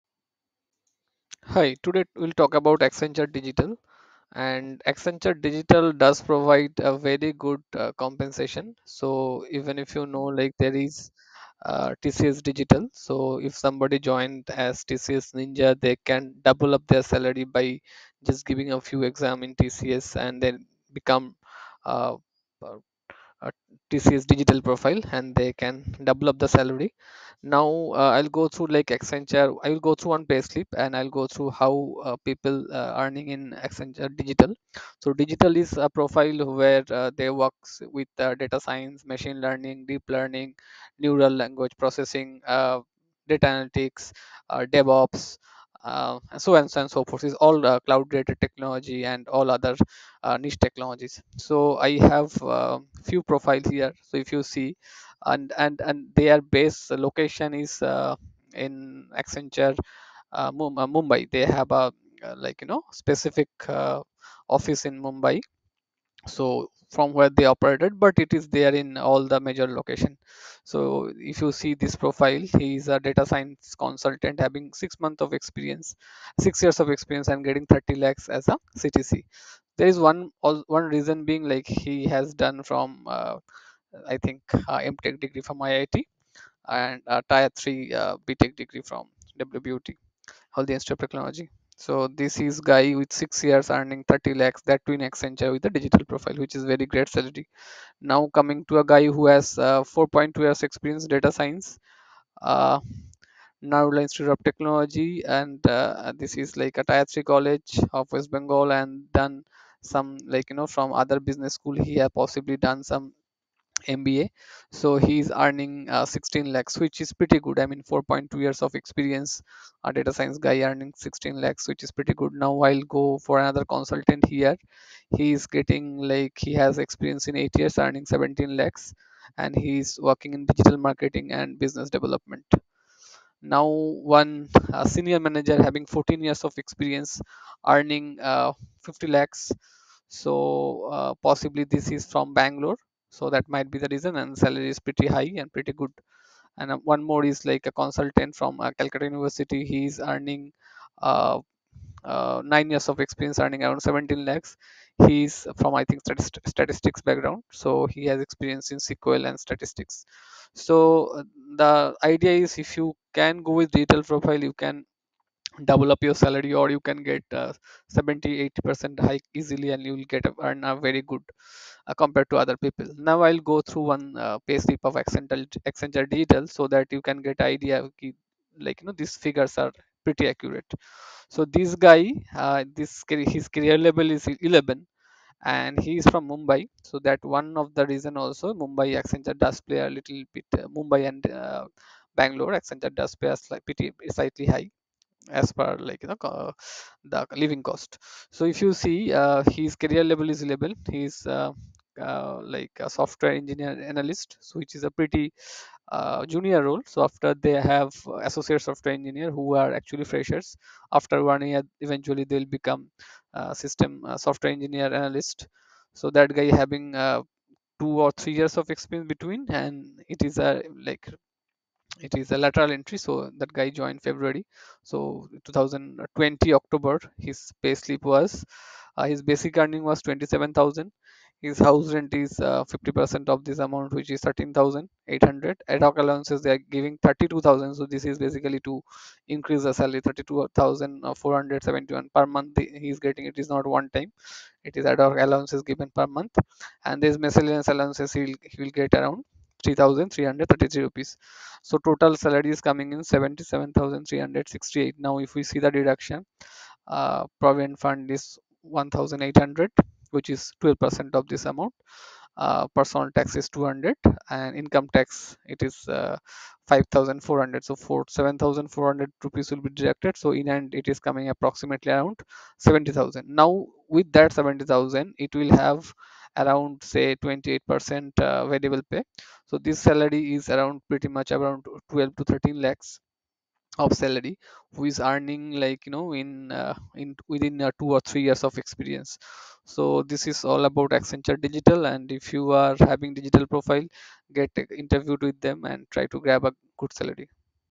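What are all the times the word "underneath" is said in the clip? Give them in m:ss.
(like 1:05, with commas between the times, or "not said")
not said.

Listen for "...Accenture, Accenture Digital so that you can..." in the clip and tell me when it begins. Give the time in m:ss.
2:55.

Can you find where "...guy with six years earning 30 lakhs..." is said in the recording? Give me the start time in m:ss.
1:32.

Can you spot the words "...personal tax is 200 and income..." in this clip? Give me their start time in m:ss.
4:22.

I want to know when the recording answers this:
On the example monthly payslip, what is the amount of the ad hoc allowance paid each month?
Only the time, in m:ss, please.
4:00.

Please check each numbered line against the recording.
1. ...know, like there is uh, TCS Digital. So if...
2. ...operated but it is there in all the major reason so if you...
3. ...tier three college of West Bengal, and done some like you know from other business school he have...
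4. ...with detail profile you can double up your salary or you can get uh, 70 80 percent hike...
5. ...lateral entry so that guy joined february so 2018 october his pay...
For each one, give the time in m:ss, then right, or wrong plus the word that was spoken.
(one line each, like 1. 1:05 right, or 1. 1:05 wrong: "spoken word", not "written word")
1. 0:10 right
2. 1:07 wrong: "location", not "reason"
3. 1:46 right
4. 2:43 right
5. 3:42 wrong: "2020", not "2018".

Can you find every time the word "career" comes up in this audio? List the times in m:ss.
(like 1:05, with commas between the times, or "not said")
3:03, 3:19.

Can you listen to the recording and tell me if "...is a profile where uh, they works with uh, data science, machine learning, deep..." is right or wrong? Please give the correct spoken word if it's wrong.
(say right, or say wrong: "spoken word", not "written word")
right.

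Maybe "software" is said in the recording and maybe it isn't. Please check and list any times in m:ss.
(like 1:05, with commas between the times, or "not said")
3:22, 3:28, 3:34.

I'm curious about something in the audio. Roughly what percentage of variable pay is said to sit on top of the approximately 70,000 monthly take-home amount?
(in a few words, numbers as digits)
28%.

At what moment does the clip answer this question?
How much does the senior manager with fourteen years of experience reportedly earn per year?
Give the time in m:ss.
2:18.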